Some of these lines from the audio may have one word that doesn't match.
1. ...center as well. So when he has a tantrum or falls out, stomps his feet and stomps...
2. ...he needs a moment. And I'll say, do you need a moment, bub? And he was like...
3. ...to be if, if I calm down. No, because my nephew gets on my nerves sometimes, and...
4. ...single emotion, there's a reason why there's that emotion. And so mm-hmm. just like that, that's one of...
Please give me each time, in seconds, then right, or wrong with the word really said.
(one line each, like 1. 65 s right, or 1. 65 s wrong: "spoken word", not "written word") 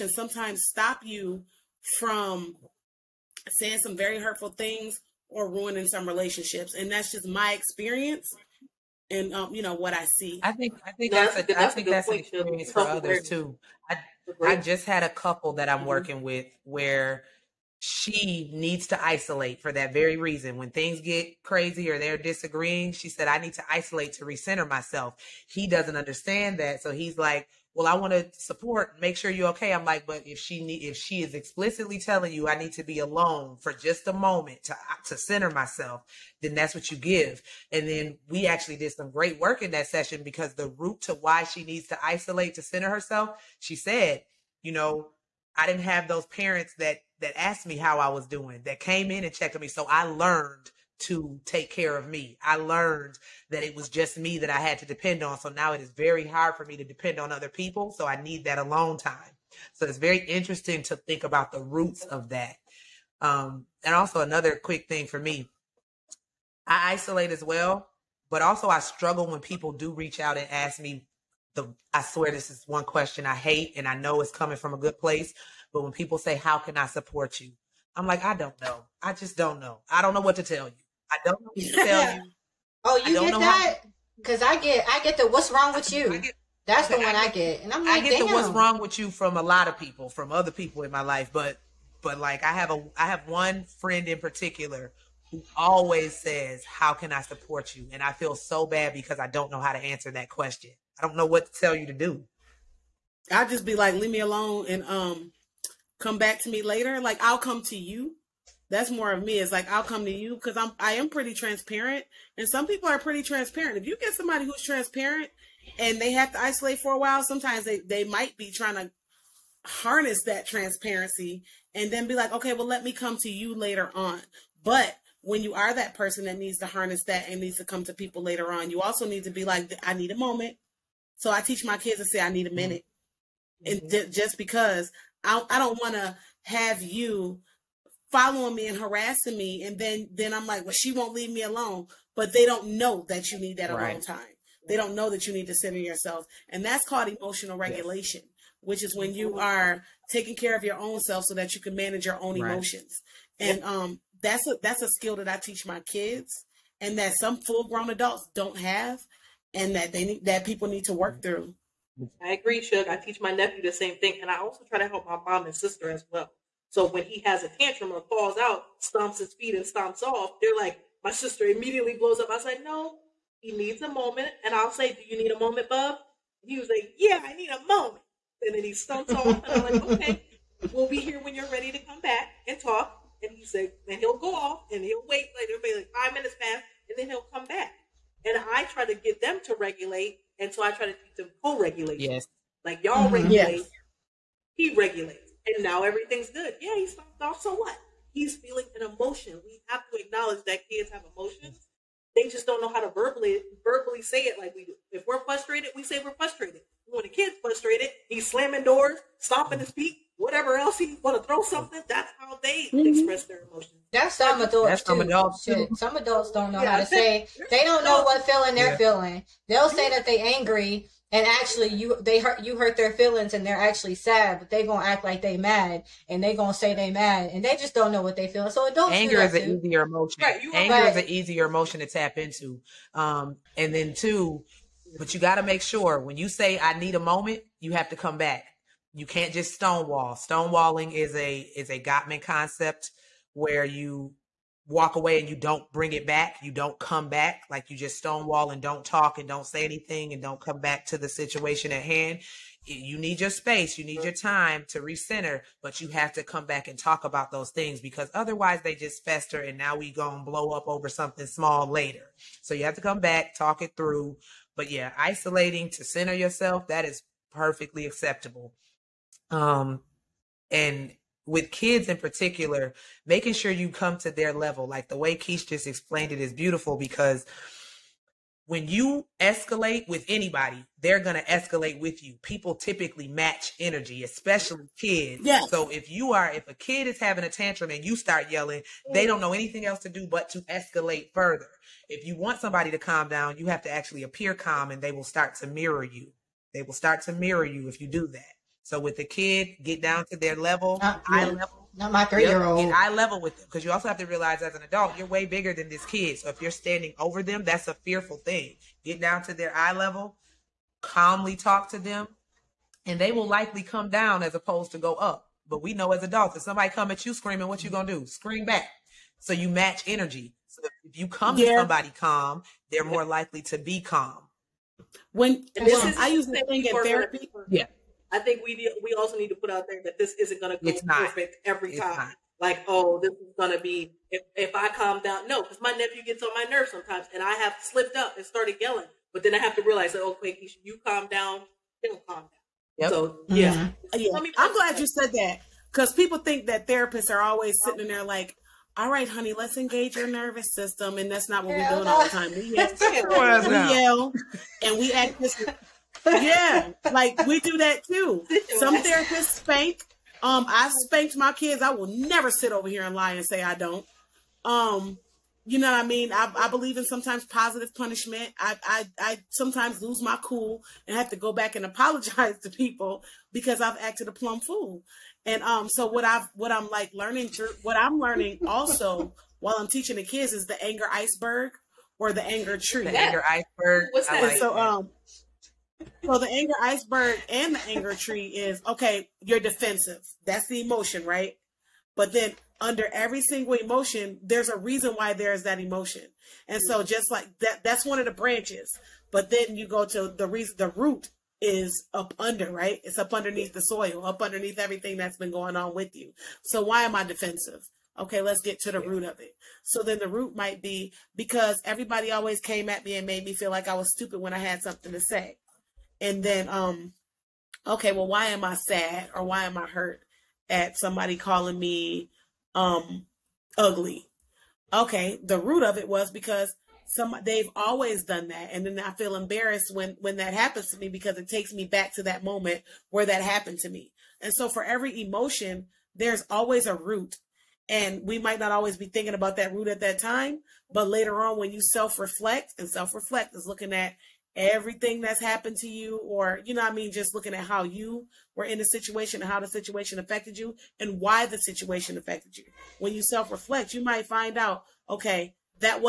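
1. 165 s wrong: "sister", not "center"
2. 173 s right
3. 333 s right
4. 393 s right.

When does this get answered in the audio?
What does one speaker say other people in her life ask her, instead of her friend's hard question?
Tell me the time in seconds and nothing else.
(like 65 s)
88 s.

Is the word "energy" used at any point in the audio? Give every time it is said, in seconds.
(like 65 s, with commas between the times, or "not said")
283 s, 319 s.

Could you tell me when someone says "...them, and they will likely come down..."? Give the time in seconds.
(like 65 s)
311 s.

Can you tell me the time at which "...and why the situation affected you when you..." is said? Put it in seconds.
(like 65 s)
450 s.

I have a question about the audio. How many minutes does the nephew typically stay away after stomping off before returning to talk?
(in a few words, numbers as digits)
5.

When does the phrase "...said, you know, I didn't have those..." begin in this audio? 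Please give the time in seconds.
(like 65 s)
43 s.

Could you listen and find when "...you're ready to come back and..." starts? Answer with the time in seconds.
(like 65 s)
181 s.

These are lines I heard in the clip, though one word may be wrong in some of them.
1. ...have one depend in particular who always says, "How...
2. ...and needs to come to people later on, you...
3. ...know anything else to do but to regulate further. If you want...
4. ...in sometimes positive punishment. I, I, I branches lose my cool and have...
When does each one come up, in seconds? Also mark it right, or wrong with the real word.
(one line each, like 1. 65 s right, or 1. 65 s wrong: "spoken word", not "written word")
1. 93 s wrong: "friend", not "depend"
2. 127 s right
3. 289 s wrong: "escalate", not "regulate"
4. 366 s wrong: "sometimes", not "branches".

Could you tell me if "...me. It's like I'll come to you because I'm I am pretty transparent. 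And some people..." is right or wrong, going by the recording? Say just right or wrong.
right.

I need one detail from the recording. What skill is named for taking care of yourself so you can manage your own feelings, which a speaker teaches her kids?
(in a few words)
Emotional regulation.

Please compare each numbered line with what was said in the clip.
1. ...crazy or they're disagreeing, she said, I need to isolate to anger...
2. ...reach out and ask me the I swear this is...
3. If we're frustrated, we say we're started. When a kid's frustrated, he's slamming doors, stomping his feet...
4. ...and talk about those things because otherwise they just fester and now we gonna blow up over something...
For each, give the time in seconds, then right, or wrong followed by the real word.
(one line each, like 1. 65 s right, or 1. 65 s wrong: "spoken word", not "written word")
1. 21 s wrong: "recenter", not "anger"
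2. 69 s right
3. 204 s wrong: "frustrated", not "started"
4. 256 s right.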